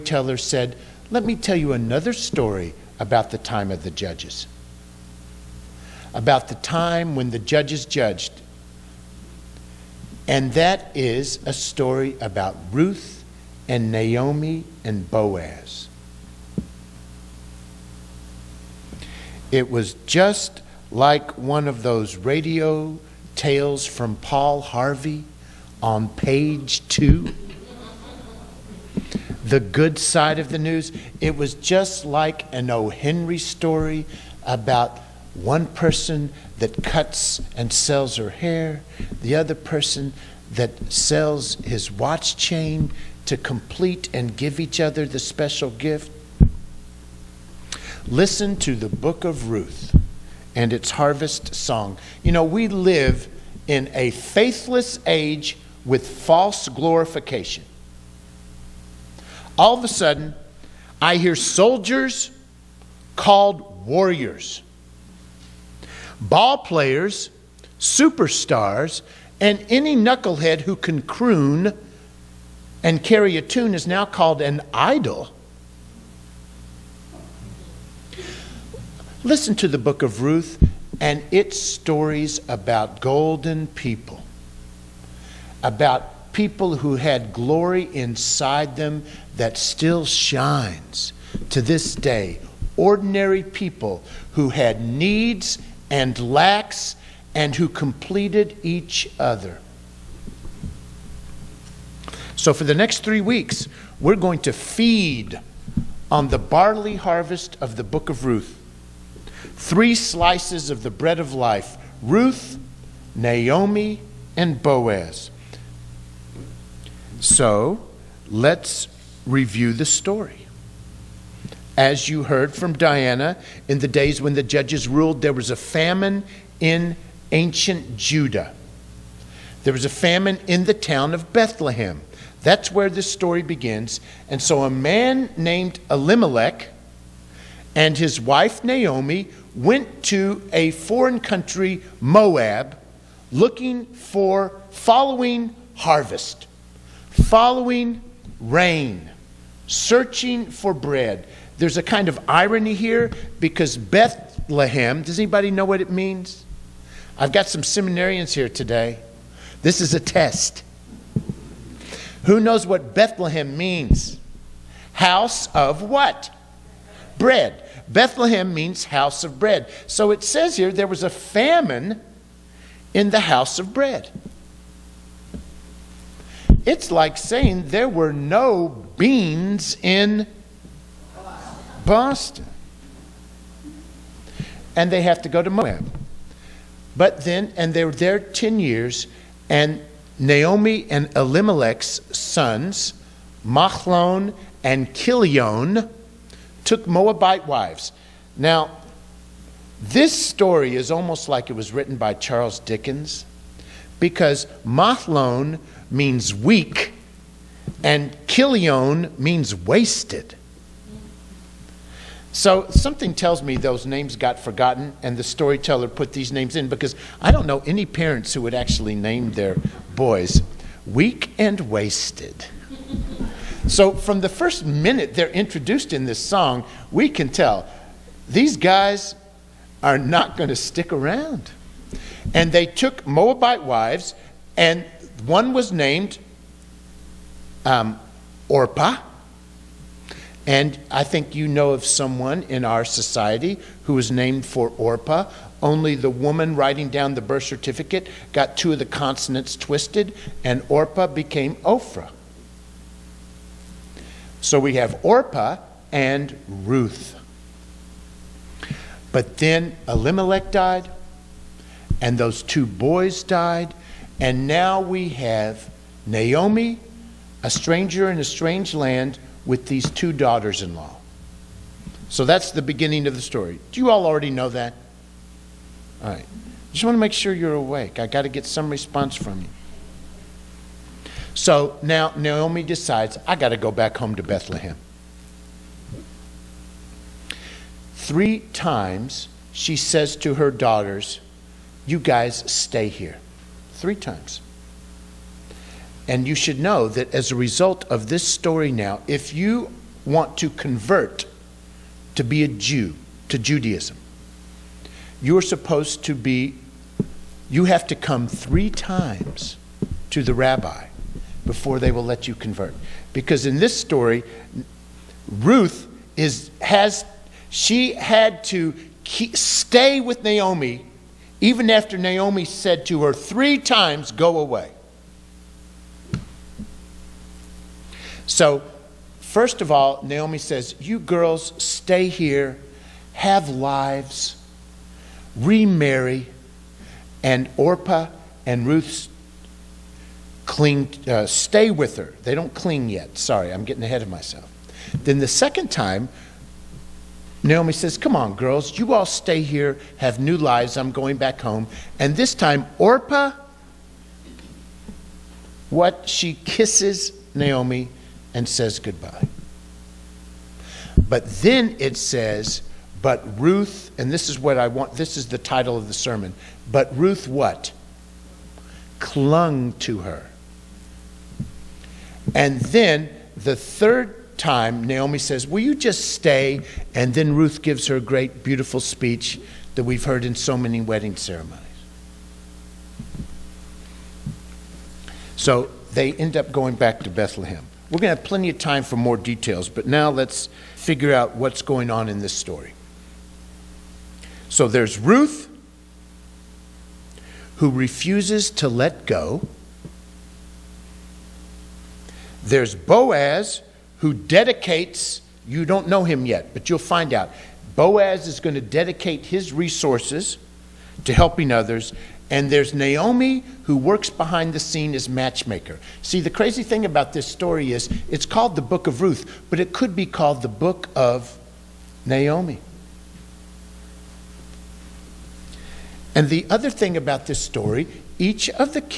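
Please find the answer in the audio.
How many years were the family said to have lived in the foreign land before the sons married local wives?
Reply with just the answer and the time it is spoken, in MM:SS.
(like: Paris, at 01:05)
10, at 03:08.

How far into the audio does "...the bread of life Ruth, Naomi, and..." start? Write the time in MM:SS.
01:50.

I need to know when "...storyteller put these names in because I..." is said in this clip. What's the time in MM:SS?
03:35.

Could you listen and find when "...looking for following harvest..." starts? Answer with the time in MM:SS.
02:23.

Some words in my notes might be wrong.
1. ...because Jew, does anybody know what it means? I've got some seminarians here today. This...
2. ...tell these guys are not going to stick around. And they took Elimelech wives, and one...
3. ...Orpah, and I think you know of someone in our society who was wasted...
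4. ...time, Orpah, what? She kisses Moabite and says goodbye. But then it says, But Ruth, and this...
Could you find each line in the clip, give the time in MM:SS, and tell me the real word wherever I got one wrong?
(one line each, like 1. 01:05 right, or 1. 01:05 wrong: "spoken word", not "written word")
1. 02:33 wrong: "Bethlehem", not "Jew"
2. 03:47 wrong: "Moabite", not "Elimelech"
3. 03:58 wrong: "named", not "wasted"
4. 05:52 wrong: "Naomi", not "Moabite".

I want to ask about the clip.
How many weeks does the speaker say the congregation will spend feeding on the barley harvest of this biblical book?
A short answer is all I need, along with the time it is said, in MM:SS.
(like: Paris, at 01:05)
3, at 01:42.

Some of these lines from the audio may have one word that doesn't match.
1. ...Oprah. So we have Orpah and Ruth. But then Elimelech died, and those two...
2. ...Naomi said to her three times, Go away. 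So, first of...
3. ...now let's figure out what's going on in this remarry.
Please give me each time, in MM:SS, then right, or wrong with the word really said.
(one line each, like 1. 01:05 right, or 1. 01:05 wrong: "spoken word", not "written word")
1. 04:11 right
2. 05:21 right
3. 06:29 wrong: "story", not "remarry".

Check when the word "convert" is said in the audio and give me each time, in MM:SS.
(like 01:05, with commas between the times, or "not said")
05:00, 05:12.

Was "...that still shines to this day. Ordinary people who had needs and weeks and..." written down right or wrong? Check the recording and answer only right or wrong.
wrong.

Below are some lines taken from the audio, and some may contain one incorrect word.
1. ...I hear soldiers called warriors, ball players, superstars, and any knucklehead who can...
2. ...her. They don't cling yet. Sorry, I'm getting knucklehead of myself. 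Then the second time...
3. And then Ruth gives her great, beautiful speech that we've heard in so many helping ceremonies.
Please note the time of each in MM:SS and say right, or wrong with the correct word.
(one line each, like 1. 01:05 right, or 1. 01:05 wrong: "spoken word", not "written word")
1. 01:01 right
2. 05:41 wrong: "ahead", not "knucklehead"
3. 06:16 wrong: "wedding", not "helping".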